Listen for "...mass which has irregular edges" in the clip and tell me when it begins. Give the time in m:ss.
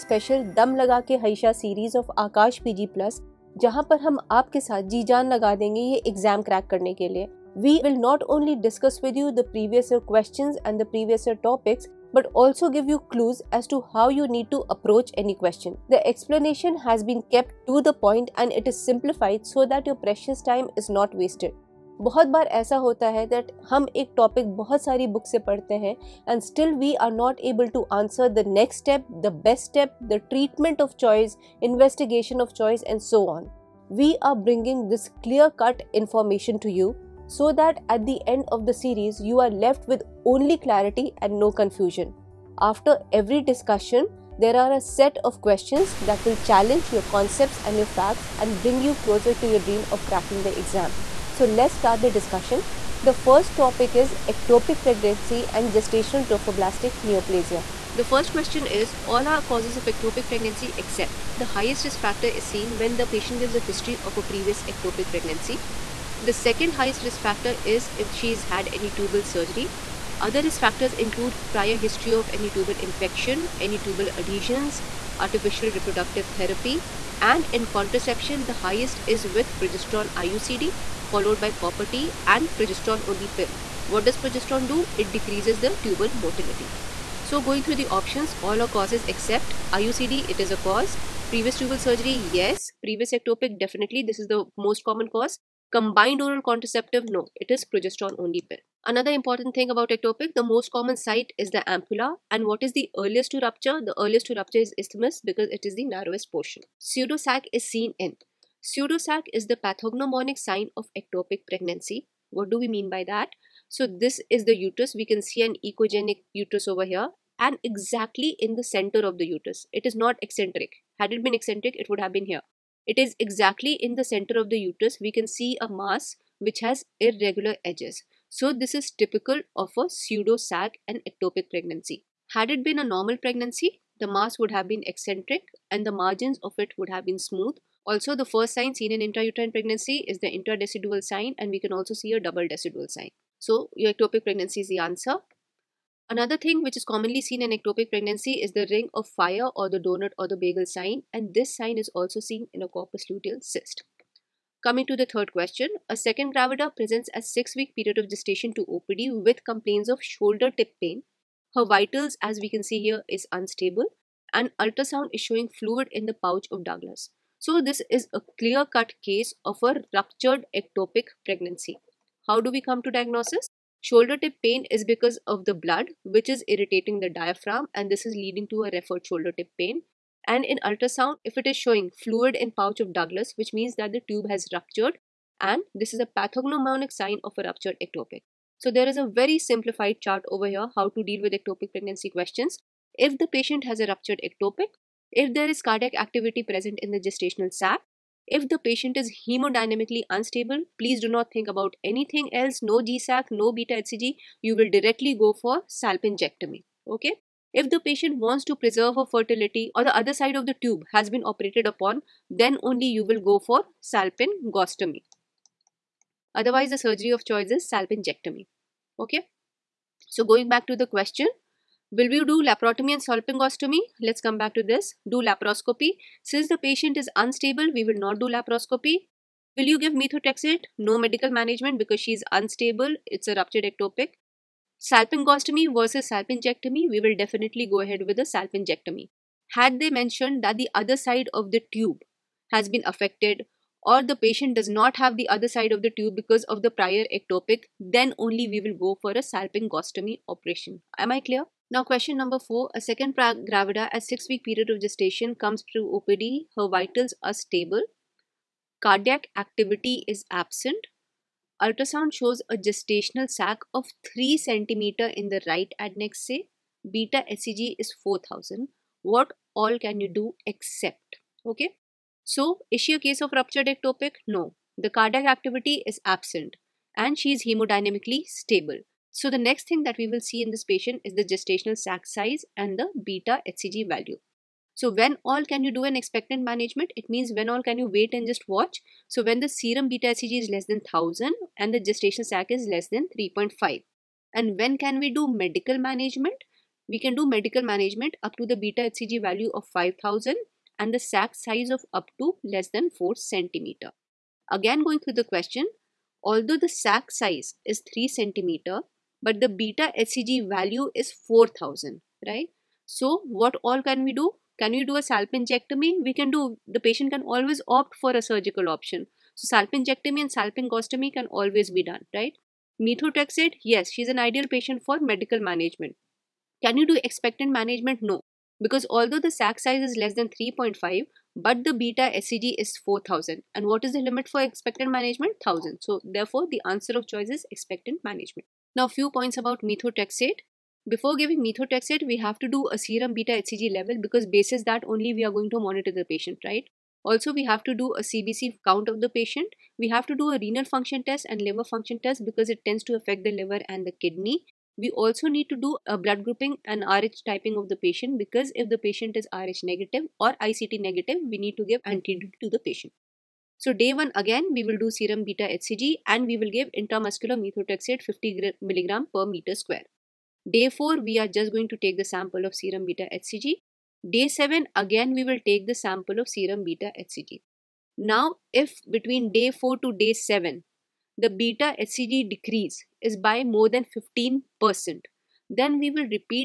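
2:05.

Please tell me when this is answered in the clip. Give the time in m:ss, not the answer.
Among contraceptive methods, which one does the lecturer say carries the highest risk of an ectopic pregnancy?
1:19.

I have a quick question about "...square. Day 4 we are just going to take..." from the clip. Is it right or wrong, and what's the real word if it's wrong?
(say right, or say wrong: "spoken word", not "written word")
right.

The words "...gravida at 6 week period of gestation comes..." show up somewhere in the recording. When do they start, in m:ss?
4:13.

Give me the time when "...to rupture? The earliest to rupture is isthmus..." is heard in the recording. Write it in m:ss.
1:43.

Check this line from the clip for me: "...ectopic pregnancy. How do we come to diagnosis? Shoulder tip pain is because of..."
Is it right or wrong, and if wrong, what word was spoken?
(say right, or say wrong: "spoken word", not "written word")
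right.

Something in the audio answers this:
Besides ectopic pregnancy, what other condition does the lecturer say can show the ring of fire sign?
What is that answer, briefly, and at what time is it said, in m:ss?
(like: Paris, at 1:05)
Corpus luteal cyst, at 2:32.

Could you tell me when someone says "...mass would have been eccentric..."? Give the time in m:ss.
2:14.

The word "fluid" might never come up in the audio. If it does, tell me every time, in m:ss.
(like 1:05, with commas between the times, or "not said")
2:45, 3:02.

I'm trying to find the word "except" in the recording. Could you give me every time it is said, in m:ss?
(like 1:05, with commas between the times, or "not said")
1:00, 1:29, 4:30.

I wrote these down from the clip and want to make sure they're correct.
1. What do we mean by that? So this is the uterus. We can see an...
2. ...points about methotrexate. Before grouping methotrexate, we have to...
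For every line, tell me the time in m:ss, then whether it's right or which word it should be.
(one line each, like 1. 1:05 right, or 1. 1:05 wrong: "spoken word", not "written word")
1. 1:52 right
2. 5:39 wrong: "giving", not "grouping".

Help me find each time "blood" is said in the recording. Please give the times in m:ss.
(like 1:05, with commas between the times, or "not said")
2:55, 5:55.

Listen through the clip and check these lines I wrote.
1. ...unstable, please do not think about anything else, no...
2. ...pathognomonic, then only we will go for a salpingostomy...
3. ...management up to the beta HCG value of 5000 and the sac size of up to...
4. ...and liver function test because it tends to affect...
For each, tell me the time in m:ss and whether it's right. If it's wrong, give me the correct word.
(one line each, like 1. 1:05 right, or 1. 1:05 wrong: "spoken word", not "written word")
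1. 3:20 right
2. 4:07 wrong: "ectopic", not "pathognomonic"
3. 4:57 right
4. 5:51 right.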